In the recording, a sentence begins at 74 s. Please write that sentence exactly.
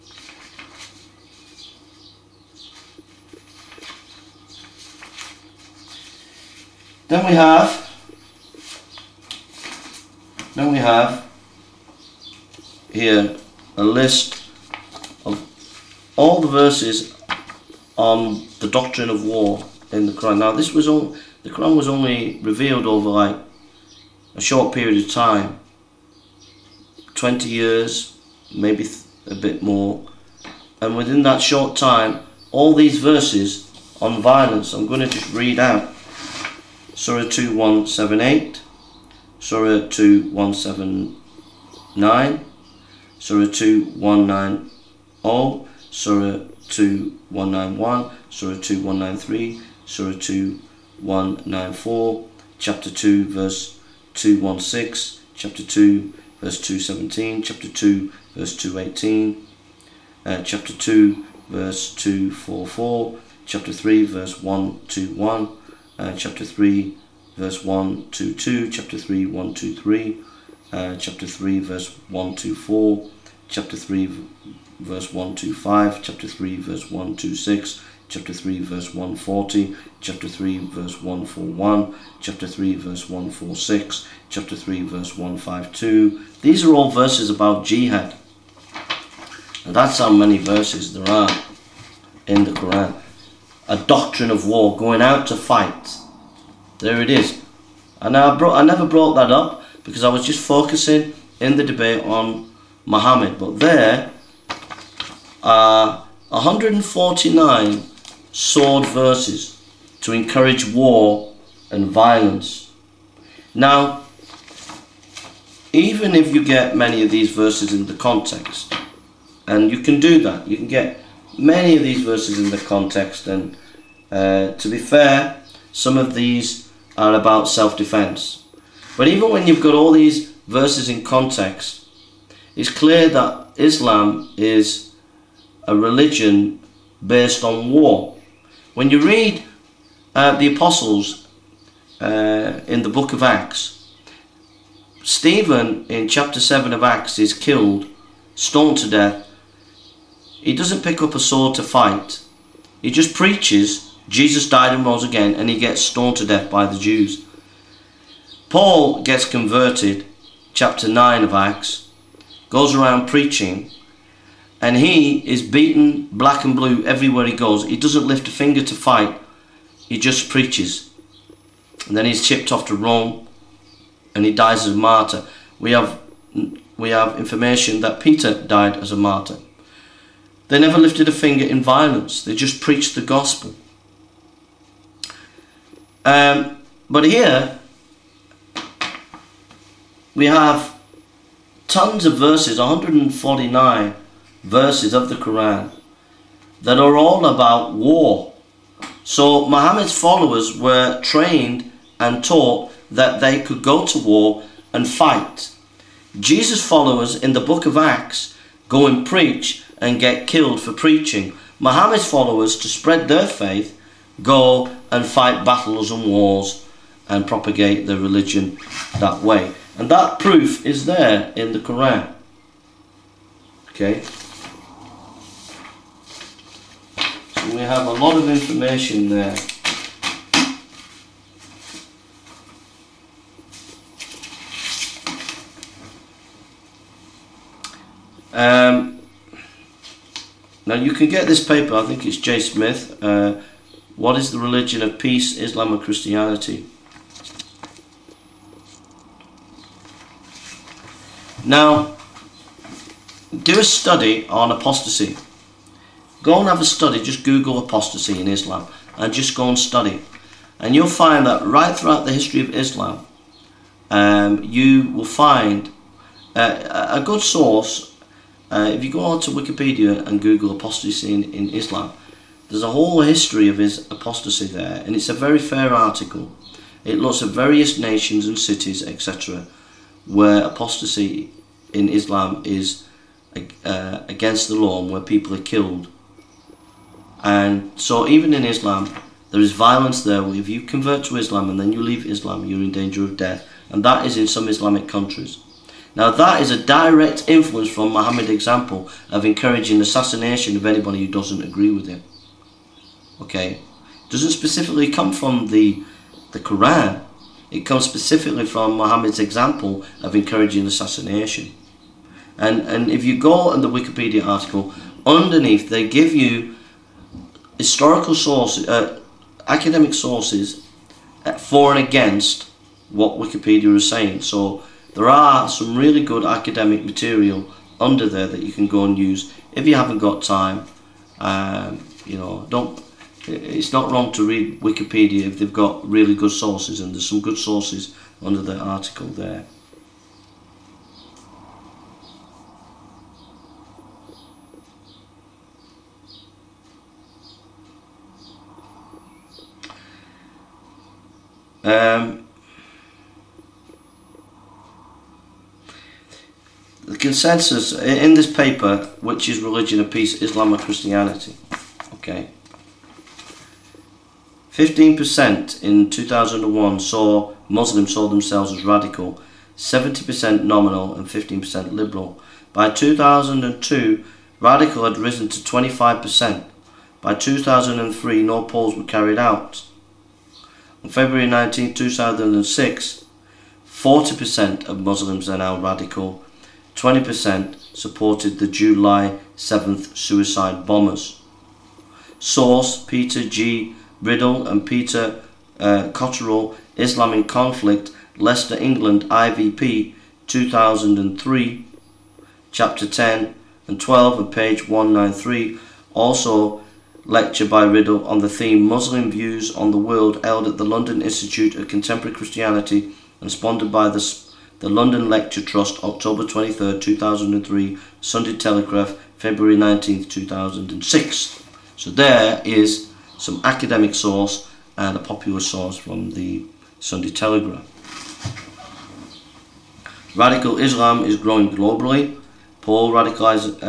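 verse 125, chapter 3, verse 126, chapter 3, verse 140, chapter 3, verse 141, chapter 3, verse 146, chapter 3, verse 152.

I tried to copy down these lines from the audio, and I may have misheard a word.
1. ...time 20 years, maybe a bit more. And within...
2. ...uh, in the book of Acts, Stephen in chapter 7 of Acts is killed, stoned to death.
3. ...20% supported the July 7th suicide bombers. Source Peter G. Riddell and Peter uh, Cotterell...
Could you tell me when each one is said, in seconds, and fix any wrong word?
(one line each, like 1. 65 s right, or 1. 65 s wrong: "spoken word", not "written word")
1. 25 s right
2. 141 s right
3. 386 s right.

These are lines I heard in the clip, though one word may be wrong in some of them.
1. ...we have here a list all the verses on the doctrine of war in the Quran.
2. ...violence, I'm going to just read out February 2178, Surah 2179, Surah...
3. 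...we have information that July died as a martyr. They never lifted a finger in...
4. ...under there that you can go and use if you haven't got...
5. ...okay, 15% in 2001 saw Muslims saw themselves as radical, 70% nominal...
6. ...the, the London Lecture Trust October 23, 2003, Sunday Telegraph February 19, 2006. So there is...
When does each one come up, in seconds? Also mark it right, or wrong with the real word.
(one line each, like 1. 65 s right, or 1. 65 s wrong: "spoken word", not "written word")
1. 10 s right
2. 34 s wrong: "Surah", not "February"
3. 176 s wrong: "Peter", not "July"
4. 327 s right
5. 361 s right
6. 413 s right.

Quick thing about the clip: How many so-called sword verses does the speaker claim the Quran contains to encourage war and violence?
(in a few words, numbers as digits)
149.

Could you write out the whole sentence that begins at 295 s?
Now that is a direct influence from Muhammad's example of encouraging assassination of anybody who doesn't agree with him.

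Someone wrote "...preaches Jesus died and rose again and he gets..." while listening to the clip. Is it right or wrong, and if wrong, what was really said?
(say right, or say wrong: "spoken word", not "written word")
right.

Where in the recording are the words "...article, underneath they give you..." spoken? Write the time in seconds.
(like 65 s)
314 s.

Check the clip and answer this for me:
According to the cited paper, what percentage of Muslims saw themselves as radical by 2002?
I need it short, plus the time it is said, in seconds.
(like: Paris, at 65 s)
25%, at 375 s.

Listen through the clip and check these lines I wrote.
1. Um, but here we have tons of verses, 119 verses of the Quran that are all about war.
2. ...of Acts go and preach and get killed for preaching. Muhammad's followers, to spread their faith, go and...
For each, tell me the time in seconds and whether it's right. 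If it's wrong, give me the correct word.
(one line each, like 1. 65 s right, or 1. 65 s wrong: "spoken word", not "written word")
1. 186 s wrong: "149", not "119"
2. 207 s right.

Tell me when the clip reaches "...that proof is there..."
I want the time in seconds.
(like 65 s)
219 s.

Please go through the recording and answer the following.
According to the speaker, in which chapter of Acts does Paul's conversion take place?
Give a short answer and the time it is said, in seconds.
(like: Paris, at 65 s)
Chapter 9, at 160 s.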